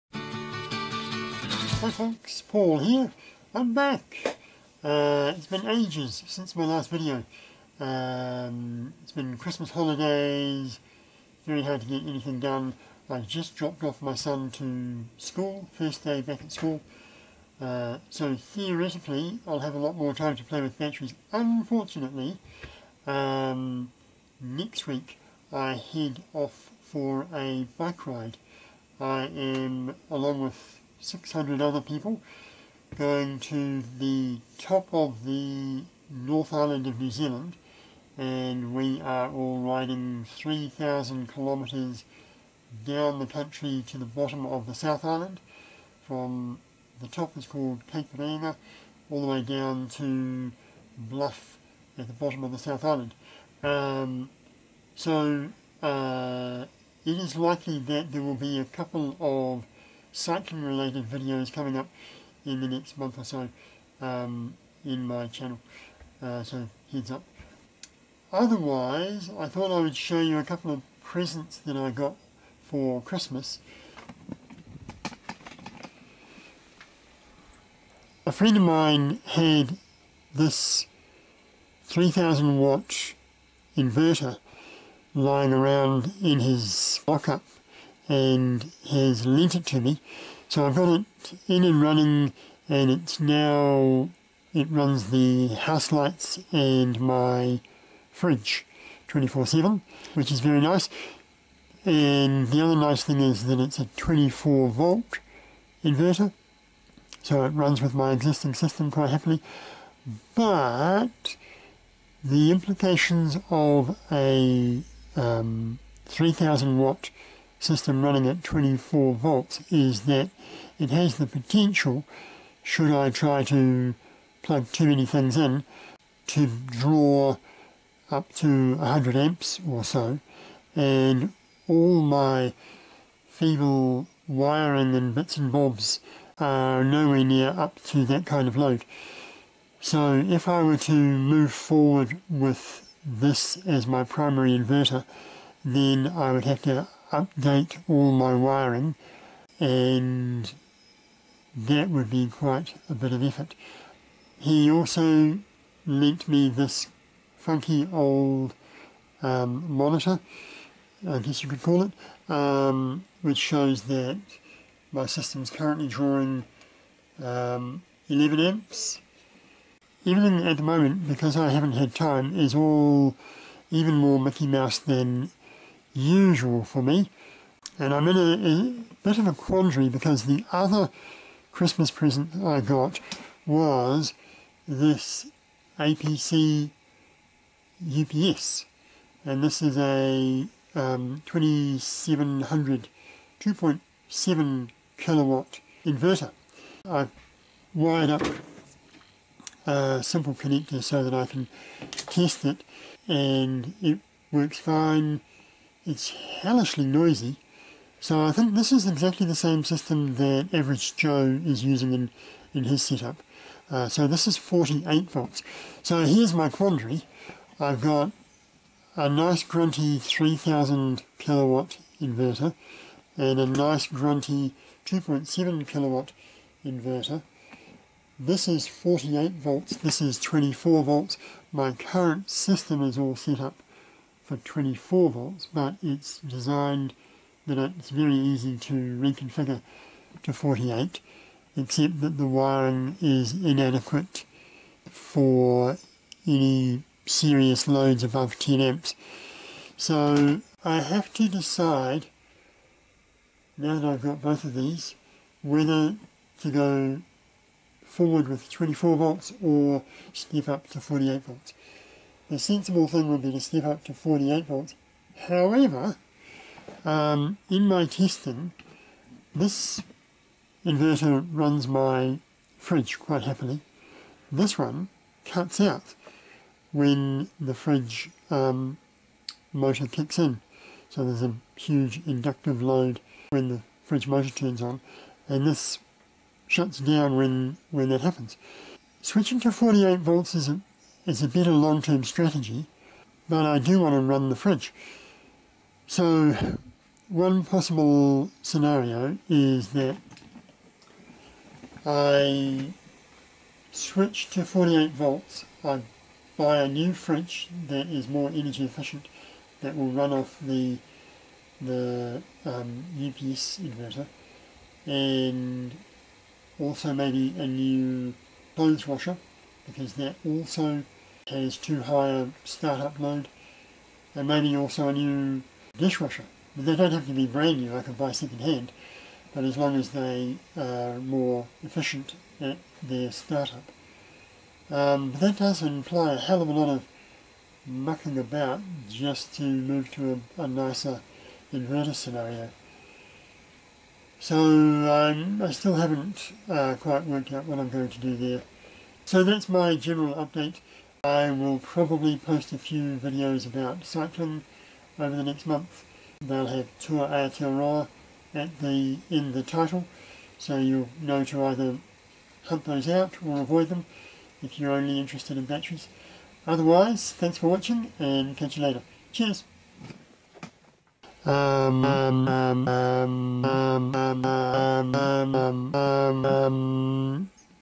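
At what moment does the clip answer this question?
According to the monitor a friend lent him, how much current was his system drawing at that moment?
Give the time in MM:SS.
02:48.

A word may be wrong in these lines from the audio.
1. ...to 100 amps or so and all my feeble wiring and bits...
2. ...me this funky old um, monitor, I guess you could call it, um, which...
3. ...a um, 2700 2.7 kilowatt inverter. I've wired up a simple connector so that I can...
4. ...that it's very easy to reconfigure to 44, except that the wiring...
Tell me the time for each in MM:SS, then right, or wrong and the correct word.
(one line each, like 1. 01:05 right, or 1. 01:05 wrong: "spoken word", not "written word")
1. 02:08 right
2. 02:36 right
3. 03:09 right
4. 03:57 wrong: "48", not "44".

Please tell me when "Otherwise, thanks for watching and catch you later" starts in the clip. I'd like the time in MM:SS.
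06:06.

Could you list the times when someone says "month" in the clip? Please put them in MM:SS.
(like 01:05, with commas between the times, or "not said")
01:02, 05:55.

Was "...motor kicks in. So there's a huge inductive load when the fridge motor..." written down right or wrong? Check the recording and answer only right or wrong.
right.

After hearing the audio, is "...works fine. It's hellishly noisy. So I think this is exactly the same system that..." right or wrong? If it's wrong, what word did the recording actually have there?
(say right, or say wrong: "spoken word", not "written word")
right.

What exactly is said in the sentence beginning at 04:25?
However, um, in my testing, this inverter runs my fridge quite happily.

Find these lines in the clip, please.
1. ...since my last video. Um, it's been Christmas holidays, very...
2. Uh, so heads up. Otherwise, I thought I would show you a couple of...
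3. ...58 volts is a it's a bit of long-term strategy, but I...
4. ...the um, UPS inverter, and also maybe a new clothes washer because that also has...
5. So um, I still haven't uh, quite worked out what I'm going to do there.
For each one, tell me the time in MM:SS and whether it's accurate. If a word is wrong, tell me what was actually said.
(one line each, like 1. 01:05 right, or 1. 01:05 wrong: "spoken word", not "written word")
1. 00:06 right
2. 01:06 right
3. 04:49 wrong: "48", not "58"
4. 05:11 right
5. 05:44 right.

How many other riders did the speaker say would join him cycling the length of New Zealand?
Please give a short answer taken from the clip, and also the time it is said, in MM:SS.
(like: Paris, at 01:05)
600, at 00:31.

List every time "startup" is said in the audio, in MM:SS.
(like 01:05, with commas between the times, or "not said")
05:22, 05:33.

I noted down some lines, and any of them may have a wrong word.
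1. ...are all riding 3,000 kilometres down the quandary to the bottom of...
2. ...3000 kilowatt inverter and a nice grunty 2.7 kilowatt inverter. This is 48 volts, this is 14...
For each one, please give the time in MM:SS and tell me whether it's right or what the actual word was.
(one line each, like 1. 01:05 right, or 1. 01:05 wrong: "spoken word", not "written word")
1. 00:39 wrong: "country", not "quandary"
2. 03:39 wrong: "24", not "14".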